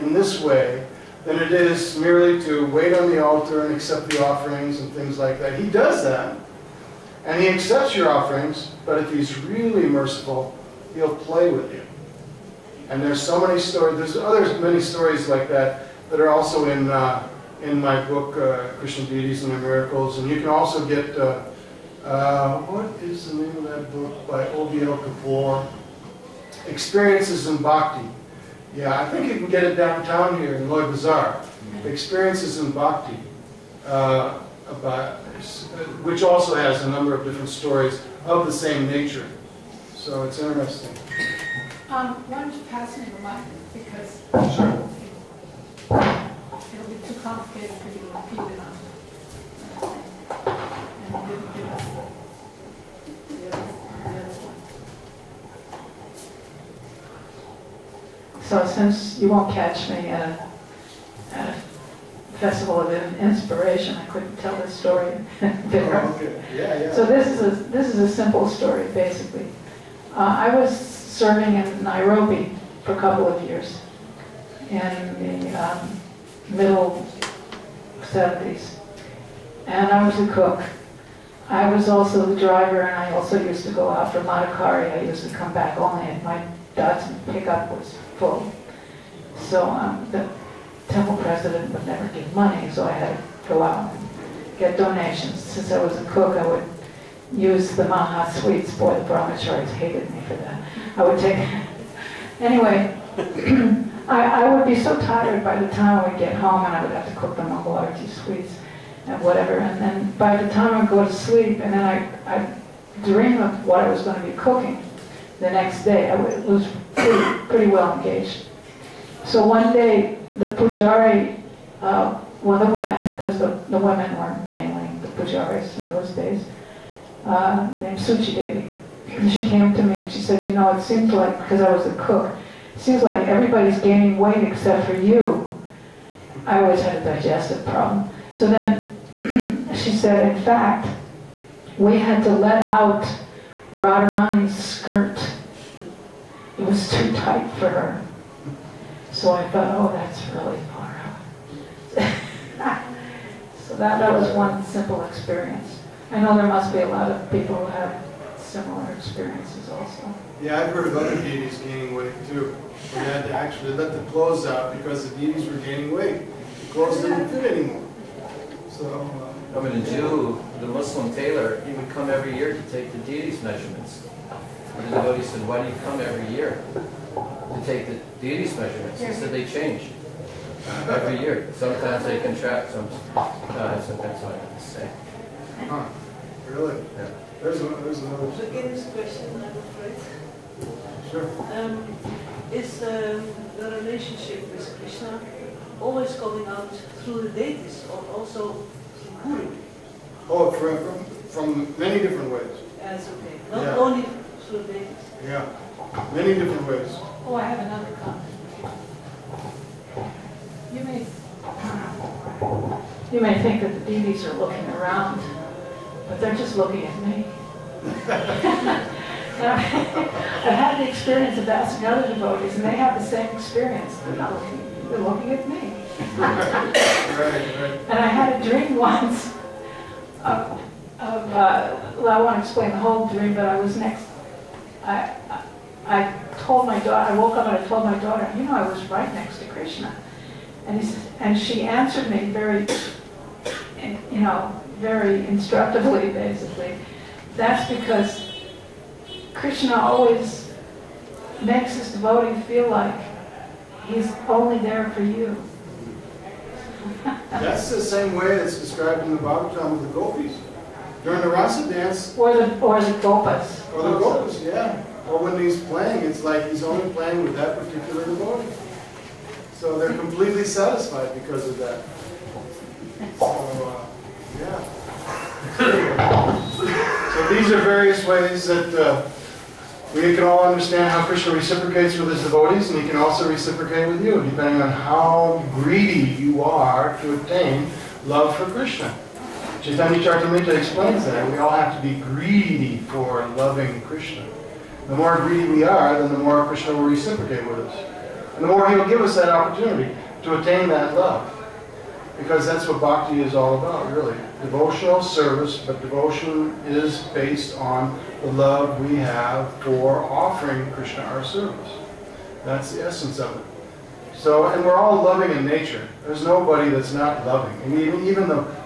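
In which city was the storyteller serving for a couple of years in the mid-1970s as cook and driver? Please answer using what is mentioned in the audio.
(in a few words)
Nairobi.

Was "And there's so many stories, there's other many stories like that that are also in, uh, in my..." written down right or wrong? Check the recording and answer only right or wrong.
right.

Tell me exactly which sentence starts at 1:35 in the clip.
Since I was a cook, I would use the Maha sweets.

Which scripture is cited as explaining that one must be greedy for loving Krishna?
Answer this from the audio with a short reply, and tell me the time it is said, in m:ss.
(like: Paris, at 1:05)
Chaitanya Charitamrita, at 4:49.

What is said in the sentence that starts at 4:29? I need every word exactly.
So they're completely satisfied because of that.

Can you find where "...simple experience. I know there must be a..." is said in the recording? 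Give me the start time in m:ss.
2:34.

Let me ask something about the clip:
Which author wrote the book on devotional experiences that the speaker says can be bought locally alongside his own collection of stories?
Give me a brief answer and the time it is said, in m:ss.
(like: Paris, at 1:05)
O.B.L. Kapoor, at 0:24.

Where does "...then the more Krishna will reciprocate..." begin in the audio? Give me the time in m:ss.
4:55.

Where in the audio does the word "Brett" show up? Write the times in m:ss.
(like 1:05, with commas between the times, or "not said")
not said.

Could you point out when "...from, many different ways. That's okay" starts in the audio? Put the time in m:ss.
3:21.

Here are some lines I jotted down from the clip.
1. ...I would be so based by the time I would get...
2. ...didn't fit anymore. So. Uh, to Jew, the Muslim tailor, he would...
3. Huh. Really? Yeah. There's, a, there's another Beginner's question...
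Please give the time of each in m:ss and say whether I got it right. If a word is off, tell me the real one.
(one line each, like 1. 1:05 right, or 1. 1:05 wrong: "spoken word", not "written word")
1. 1:44 wrong: "tired", not "based"
2. 2:47 right
3. 3:05 right.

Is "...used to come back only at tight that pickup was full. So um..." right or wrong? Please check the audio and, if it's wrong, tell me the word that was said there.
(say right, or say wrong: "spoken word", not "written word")
wrong: "night", not "tight".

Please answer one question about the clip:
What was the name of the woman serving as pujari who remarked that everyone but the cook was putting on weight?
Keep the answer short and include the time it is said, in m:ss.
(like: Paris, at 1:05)
Suchi Devi, at 2:07.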